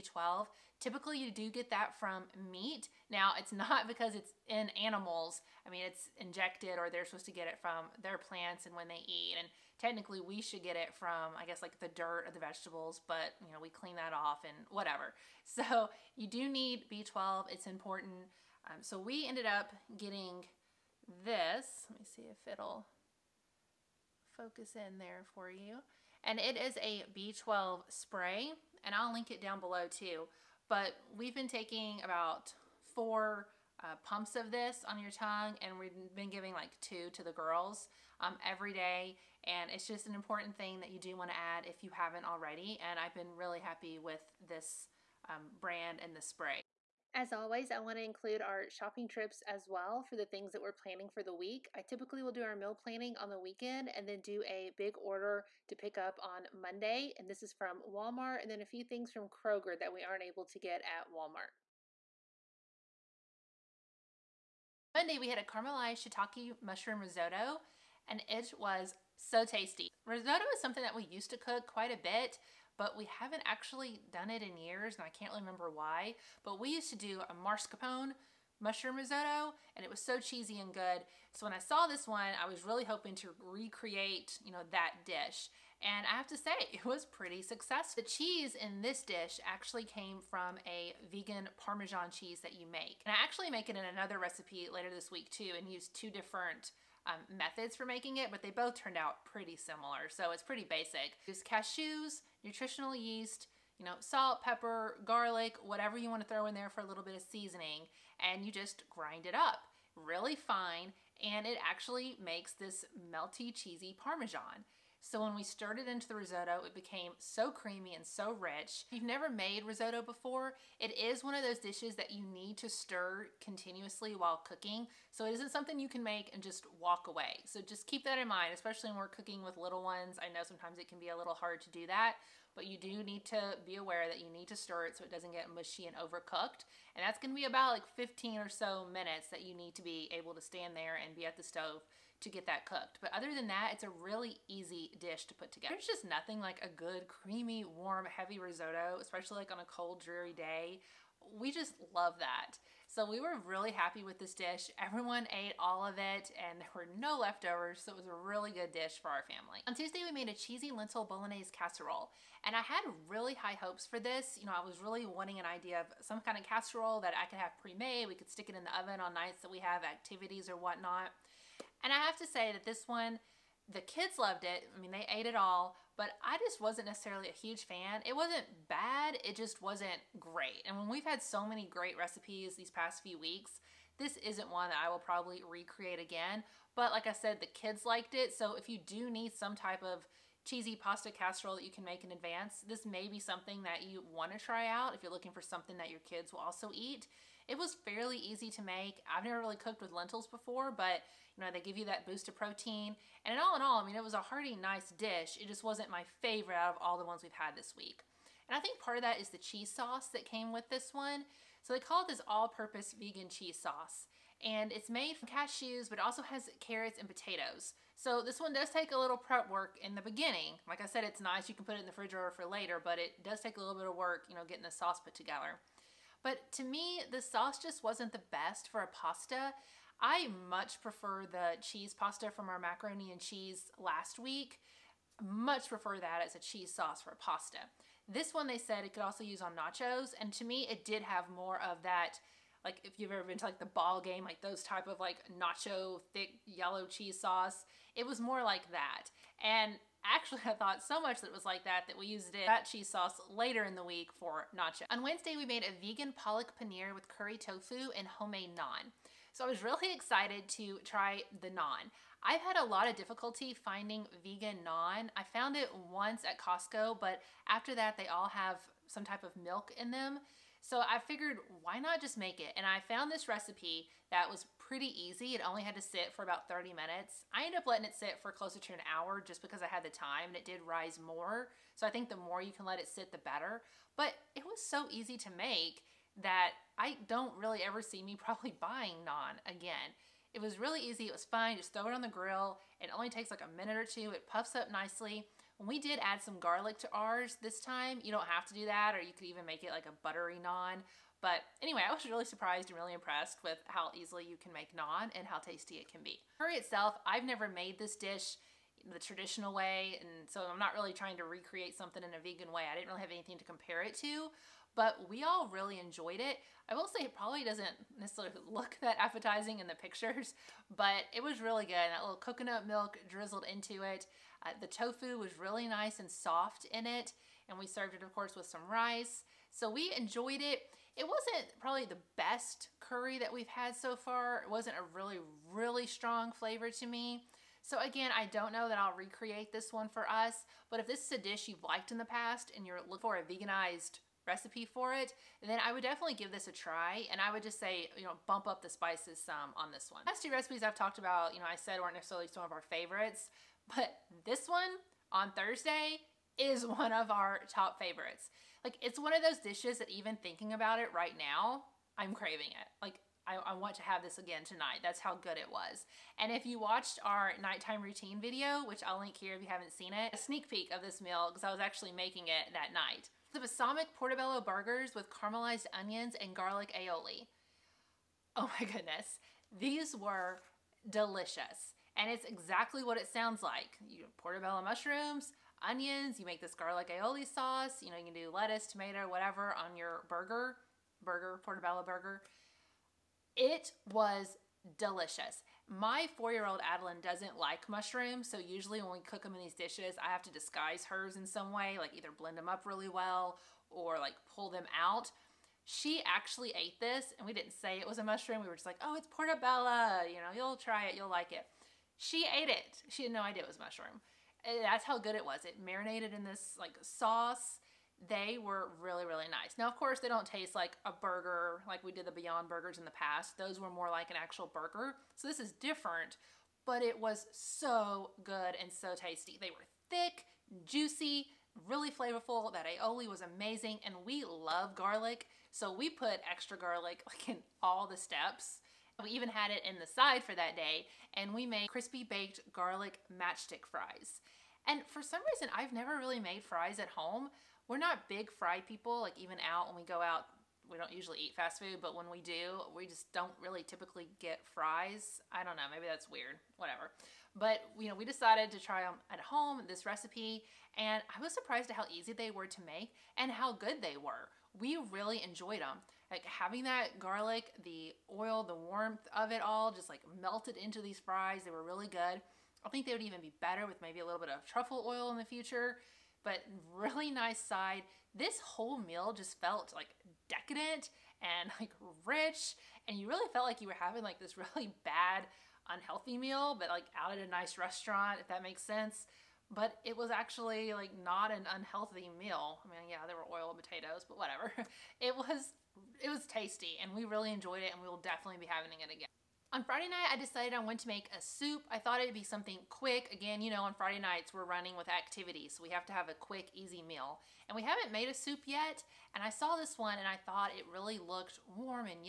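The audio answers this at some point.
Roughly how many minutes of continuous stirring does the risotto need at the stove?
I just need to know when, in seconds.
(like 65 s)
137 s.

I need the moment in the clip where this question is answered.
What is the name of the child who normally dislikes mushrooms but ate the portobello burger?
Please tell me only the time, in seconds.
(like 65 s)
396 s.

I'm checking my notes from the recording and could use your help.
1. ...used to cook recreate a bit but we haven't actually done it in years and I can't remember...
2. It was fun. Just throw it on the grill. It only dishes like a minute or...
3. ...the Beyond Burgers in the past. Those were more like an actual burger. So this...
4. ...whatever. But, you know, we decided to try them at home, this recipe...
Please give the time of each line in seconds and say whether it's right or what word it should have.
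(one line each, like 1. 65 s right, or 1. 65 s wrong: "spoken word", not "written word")
1. 71 s wrong: "quite", not "recreate"
2. 291 s wrong: "takes", not "dishes"
3. 422 s right
4. 456 s right.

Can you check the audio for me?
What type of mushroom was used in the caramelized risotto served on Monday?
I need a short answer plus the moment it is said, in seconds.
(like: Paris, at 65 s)
Shiitake, at 66 s.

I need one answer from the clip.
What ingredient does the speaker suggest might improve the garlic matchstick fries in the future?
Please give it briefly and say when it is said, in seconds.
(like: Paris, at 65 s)
Truffle oil, at 474 s.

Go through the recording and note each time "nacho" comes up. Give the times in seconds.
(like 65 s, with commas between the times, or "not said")
239 s, 245 s, 254 s.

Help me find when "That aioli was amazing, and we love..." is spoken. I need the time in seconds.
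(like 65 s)
432 s.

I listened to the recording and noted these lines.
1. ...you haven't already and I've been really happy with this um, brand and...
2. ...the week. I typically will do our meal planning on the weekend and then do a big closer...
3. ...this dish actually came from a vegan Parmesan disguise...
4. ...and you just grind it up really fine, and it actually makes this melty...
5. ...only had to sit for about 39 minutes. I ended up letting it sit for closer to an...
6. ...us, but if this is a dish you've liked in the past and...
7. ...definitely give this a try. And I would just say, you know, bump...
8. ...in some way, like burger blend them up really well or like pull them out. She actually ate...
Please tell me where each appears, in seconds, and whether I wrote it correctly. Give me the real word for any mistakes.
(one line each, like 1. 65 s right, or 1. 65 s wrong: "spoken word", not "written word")
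1. 41 s right
2. 51 s wrong: "order", not "closer"
3. 88 s wrong: "cheese", not "disguise"
4. 108 s right
5. 275 s wrong: "30", not "39"
6. 340 s right
7. 345 s right
8. 401 s wrong: "either", not "burger".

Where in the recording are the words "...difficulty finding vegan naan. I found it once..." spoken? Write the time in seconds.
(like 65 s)
262 s.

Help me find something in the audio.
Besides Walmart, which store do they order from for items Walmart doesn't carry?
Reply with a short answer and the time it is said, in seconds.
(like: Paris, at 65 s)
Kroger, at 59 s.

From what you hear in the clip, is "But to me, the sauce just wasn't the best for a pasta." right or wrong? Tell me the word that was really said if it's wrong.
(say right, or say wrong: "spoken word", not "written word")
right.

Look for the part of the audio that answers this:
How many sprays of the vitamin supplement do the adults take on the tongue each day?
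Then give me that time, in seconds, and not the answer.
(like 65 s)
32 s.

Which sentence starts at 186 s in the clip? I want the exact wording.
But like I said, the kids liked it.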